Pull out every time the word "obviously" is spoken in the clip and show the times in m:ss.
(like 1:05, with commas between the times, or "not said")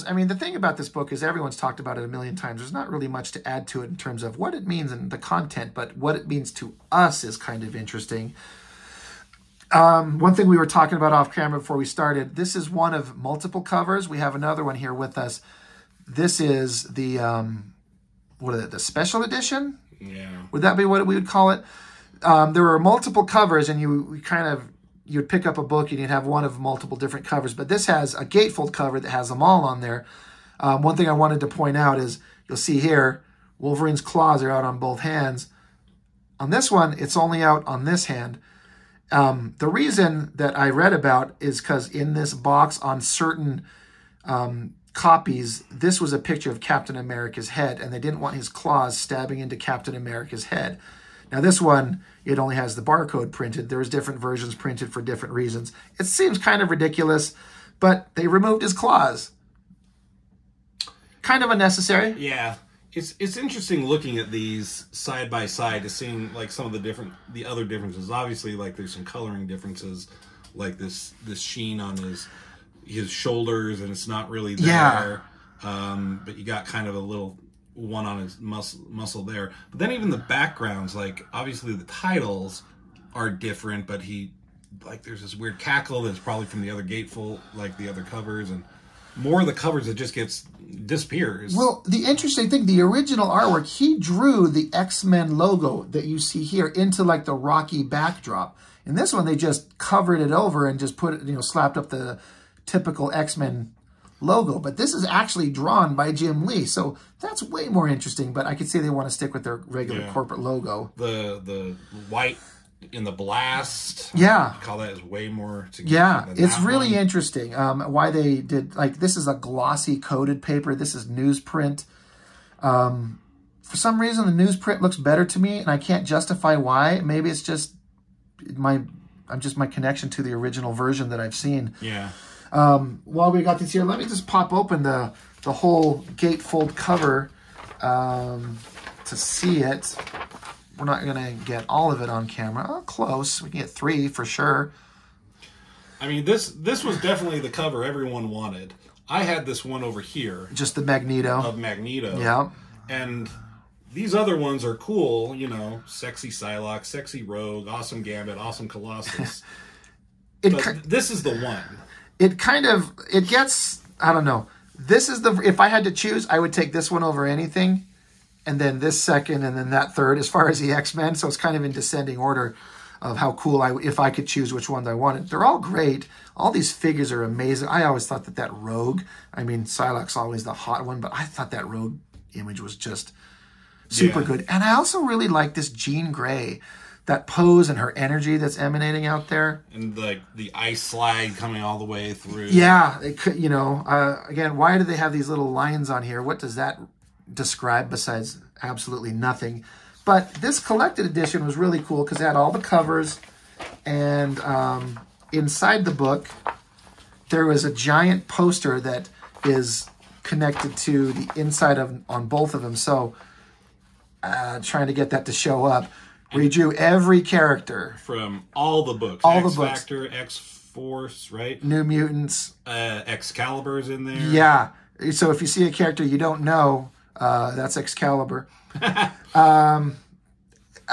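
1:08, 1:21.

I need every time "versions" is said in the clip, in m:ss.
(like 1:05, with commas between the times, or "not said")
0:54, 2:10.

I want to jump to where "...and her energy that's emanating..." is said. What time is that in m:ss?
3:07.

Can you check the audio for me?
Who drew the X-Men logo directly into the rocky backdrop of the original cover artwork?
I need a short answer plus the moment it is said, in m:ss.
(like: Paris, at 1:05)
Jim Lee, at 1:46.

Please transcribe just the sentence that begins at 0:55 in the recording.
It seems kind of ridiculous, but they removed his claws.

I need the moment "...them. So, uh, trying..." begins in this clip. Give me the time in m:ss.
3:32.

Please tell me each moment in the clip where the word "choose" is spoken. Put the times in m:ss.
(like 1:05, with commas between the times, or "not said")
2:45, 2:54.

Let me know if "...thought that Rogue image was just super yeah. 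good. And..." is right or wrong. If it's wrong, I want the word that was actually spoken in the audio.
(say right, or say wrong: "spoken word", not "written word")
right.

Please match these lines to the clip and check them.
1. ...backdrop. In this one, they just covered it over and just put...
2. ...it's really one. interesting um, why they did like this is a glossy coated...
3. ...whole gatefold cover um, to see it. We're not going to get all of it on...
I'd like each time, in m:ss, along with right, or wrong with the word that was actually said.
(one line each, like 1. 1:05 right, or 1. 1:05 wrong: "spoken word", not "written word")
1. 1:37 right
2. 1:56 right
3. 2:15 right.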